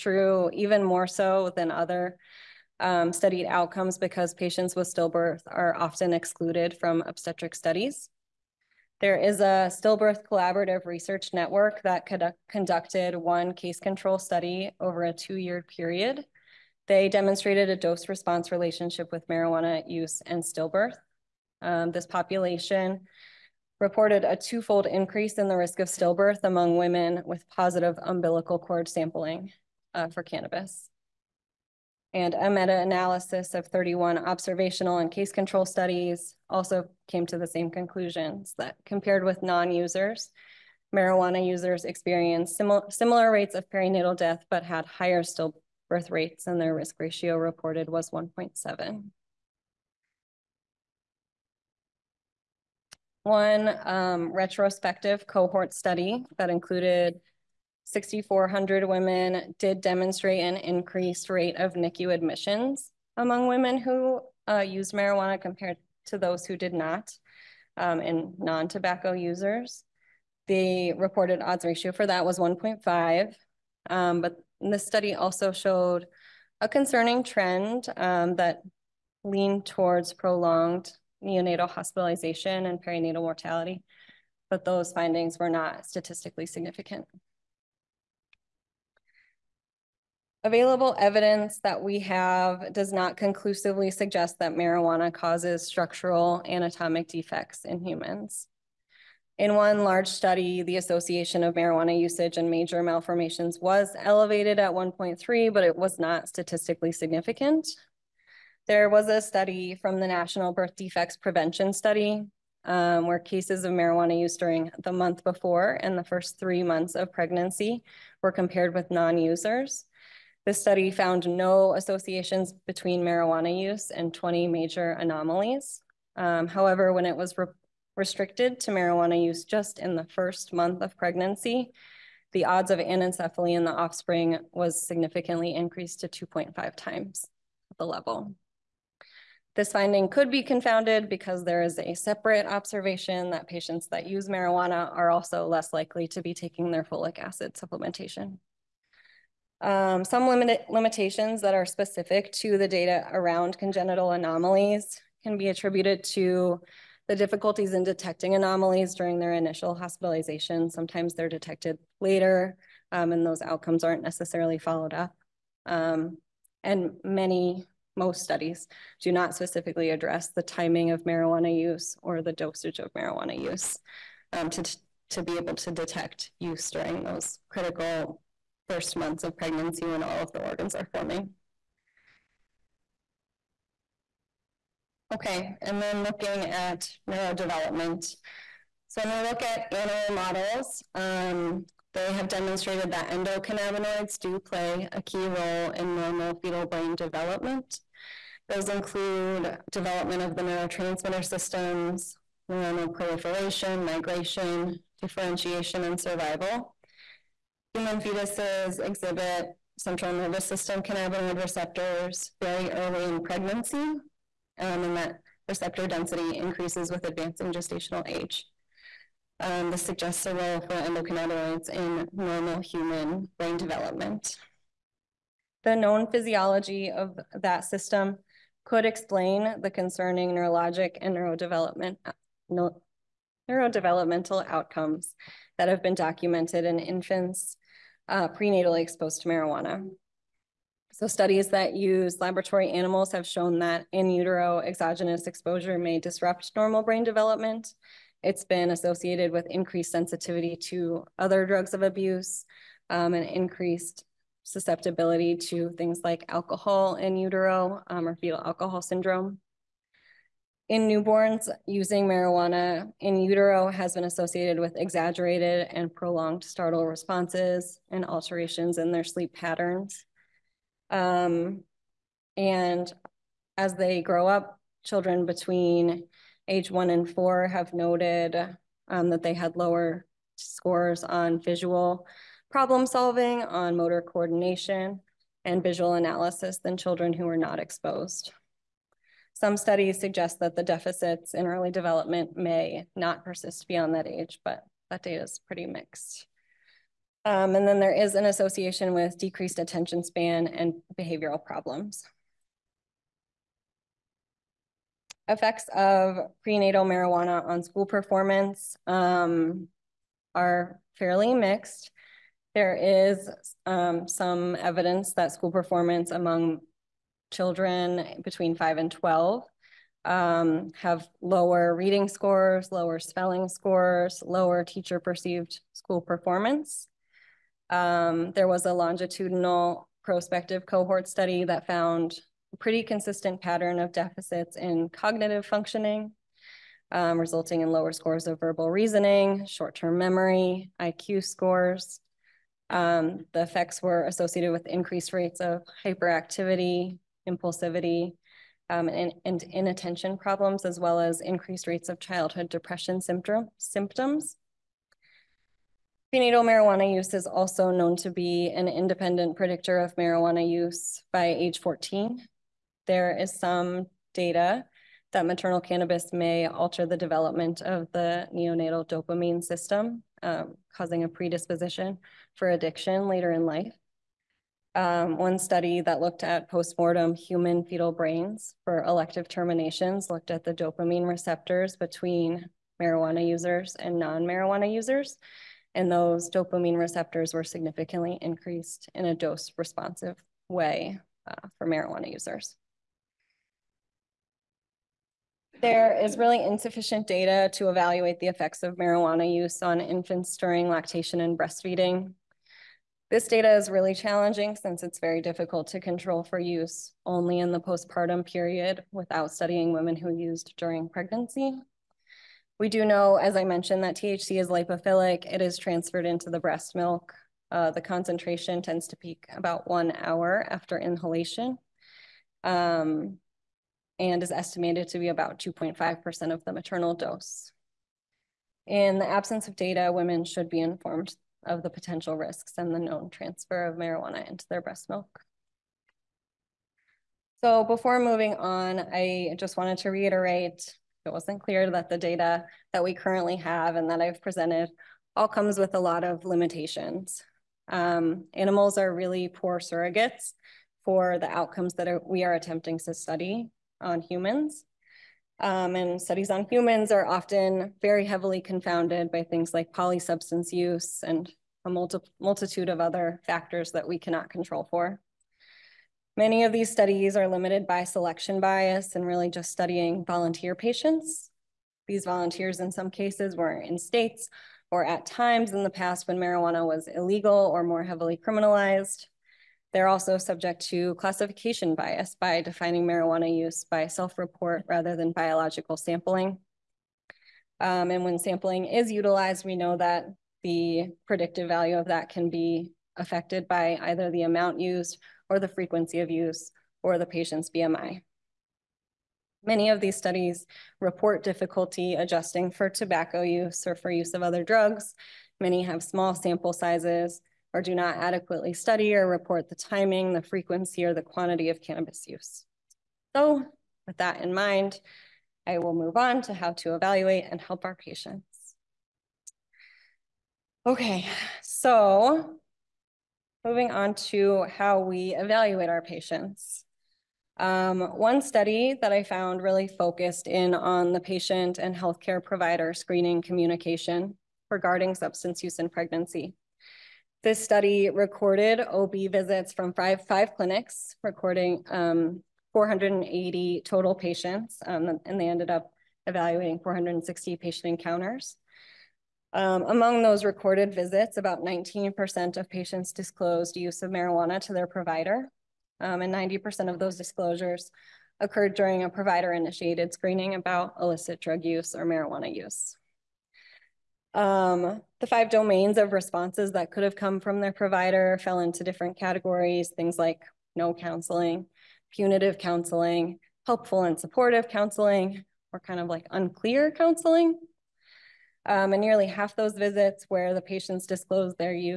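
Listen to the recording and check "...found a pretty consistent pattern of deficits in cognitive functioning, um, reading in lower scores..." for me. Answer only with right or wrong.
wrong.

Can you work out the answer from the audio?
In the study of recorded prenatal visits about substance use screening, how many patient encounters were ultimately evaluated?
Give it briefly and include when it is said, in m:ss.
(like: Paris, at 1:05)
460, at 9:06.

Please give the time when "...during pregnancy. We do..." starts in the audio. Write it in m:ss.
6:50.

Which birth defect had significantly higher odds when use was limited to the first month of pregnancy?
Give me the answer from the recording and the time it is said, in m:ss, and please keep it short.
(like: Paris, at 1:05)
anencephaly, at 2:12.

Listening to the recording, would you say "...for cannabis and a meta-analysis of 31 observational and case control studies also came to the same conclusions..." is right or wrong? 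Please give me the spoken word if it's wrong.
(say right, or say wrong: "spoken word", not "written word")
right.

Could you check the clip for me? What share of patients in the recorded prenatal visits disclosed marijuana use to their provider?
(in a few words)
19%.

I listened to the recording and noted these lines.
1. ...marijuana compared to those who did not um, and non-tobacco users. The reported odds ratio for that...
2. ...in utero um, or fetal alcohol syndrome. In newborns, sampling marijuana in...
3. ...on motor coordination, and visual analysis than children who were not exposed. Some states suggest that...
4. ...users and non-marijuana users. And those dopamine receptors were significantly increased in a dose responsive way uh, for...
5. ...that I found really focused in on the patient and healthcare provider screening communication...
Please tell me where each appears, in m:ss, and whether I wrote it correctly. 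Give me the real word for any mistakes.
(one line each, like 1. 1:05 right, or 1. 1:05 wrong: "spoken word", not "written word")
1. 1:04 right
2. 4:16 wrong: "using", not "sampling"
3. 4:43 wrong: "studies", not "states"
4. 6:23 right
5. 8:48 right.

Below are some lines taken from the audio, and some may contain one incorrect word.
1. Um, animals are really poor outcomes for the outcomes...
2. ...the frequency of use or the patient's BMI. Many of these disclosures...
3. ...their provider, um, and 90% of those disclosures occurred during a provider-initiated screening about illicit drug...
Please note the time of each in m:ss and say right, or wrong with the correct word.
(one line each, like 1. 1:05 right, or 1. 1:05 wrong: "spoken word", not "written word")
1. 7:27 wrong: "surrogates", not "outcomes"
2. 8:15 wrong: "studies", not "disclosures"
3. 9:14 right.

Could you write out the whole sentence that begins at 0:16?
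They demonstrated a dose response relationship with marijuana use and stillbirth.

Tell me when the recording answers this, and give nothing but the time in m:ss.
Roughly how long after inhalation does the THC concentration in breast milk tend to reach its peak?
6:59.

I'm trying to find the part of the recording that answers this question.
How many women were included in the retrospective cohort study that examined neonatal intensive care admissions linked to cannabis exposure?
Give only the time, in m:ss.
0:57.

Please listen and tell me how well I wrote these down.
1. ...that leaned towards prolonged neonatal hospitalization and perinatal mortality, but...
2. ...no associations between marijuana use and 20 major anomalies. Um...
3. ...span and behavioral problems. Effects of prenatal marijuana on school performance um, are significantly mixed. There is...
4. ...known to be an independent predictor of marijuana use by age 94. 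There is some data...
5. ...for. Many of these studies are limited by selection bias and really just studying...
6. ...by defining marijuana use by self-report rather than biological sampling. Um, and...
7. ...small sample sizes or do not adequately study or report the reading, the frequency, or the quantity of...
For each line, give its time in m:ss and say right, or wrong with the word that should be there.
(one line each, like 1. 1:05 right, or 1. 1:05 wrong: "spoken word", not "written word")
1. 1:18 right
2. 2:01 right
3. 5:00 wrong: "fairly", not "significantly"
4. 5:57 wrong: "14", not "94"
5. 7:44 right
6. 8:02 right
7. 8:25 wrong: "timing", not "reading".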